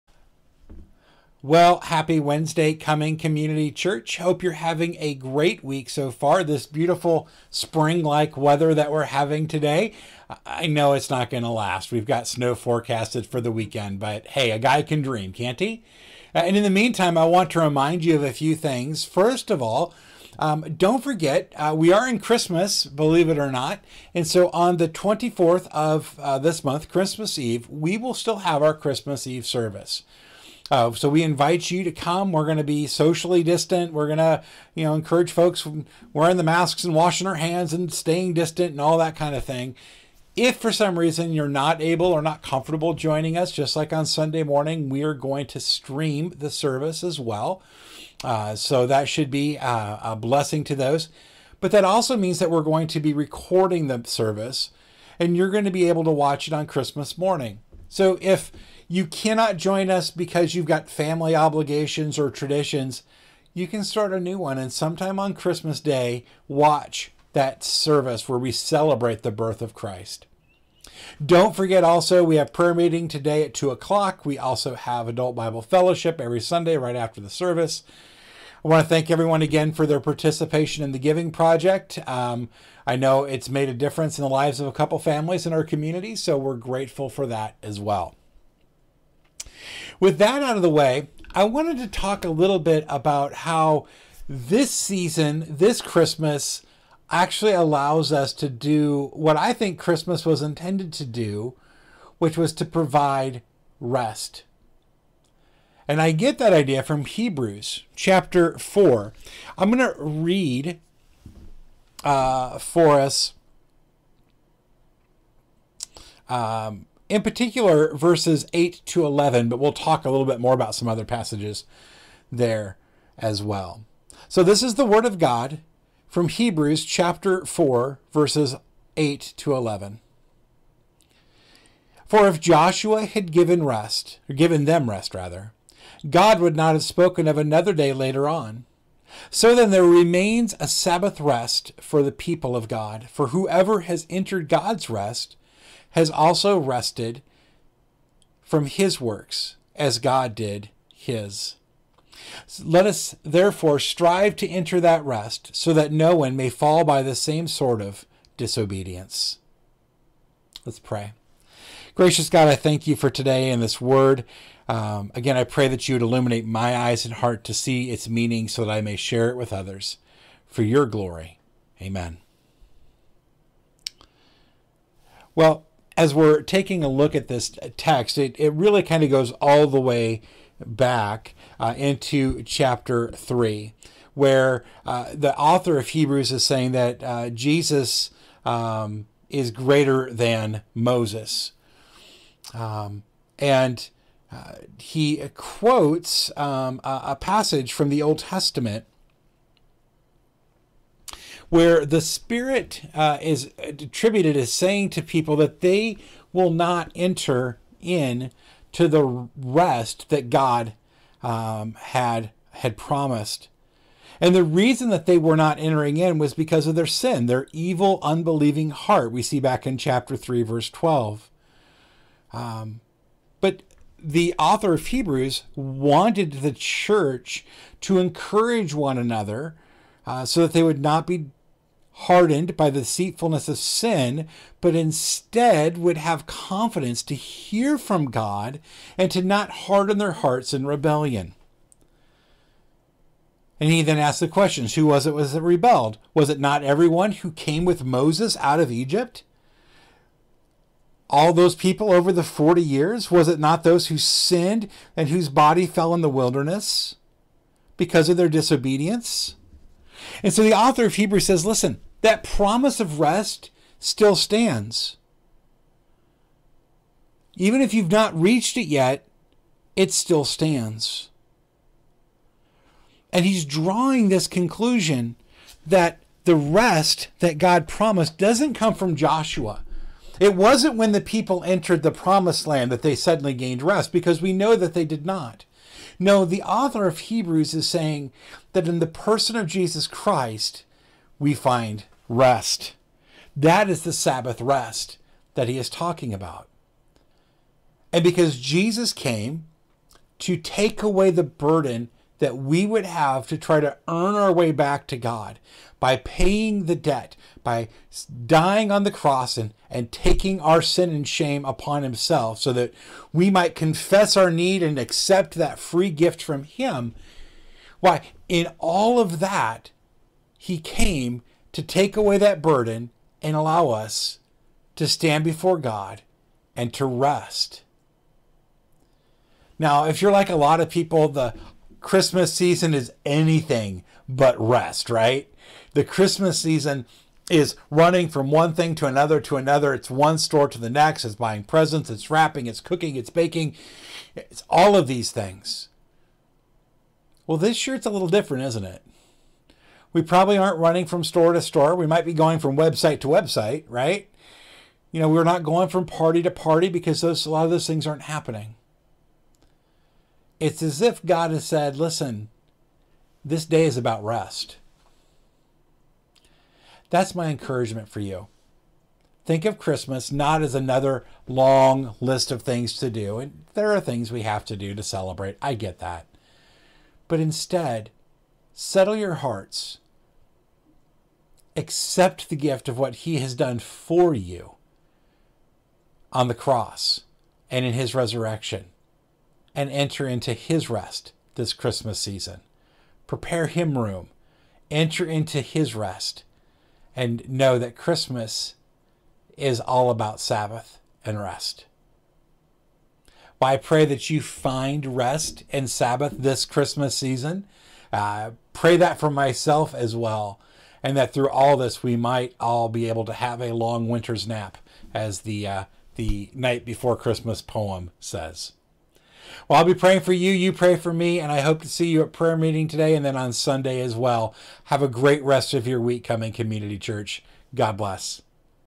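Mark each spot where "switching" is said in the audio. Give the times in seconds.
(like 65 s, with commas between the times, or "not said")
not said.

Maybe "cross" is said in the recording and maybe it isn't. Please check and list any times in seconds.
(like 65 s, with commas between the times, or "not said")
308 s, 386 s.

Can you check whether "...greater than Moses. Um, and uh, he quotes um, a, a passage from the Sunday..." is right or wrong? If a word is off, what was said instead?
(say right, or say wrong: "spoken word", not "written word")
wrong: "Old", not "Sunday".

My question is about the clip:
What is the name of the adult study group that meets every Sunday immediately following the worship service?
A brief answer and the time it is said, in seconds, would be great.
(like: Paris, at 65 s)
Adult Bible Fellowship, at 75 s.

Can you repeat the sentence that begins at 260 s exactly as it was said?
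And so the author of Hebrews says, listen, that promise of rest still stands.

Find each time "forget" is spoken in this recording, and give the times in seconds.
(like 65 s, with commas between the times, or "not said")
21 s, 71 s.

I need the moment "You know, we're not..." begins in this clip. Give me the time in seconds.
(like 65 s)
354 s.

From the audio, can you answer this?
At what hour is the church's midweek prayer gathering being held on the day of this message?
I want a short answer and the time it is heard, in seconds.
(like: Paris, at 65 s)
2 o'clock, at 73 s.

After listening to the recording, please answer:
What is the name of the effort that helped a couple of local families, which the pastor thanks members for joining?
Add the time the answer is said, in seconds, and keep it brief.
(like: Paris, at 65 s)
Giving Project, at 80 s.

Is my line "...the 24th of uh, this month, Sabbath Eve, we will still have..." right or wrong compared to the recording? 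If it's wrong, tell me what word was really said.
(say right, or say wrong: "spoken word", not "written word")
wrong: "Christmas", not "Sabbath".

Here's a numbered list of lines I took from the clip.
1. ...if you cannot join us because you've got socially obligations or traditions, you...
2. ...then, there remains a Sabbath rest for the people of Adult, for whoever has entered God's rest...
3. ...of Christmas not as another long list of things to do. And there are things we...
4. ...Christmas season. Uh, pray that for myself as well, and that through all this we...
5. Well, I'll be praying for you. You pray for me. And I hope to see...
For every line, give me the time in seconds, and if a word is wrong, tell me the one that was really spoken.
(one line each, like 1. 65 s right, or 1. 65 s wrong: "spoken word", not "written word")
1. 58 s wrong: "family", not "socially"
2. 139 s wrong: "God", not "Adult"
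3. 369 s right
4. 406 s right
5. 419 s right.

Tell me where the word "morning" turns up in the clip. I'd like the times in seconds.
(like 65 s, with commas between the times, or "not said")
44 s, 57 s.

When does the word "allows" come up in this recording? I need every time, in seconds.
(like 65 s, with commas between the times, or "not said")
97 s, 323 s.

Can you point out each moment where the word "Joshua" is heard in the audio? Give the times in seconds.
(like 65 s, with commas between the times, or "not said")
132 s, 278 s.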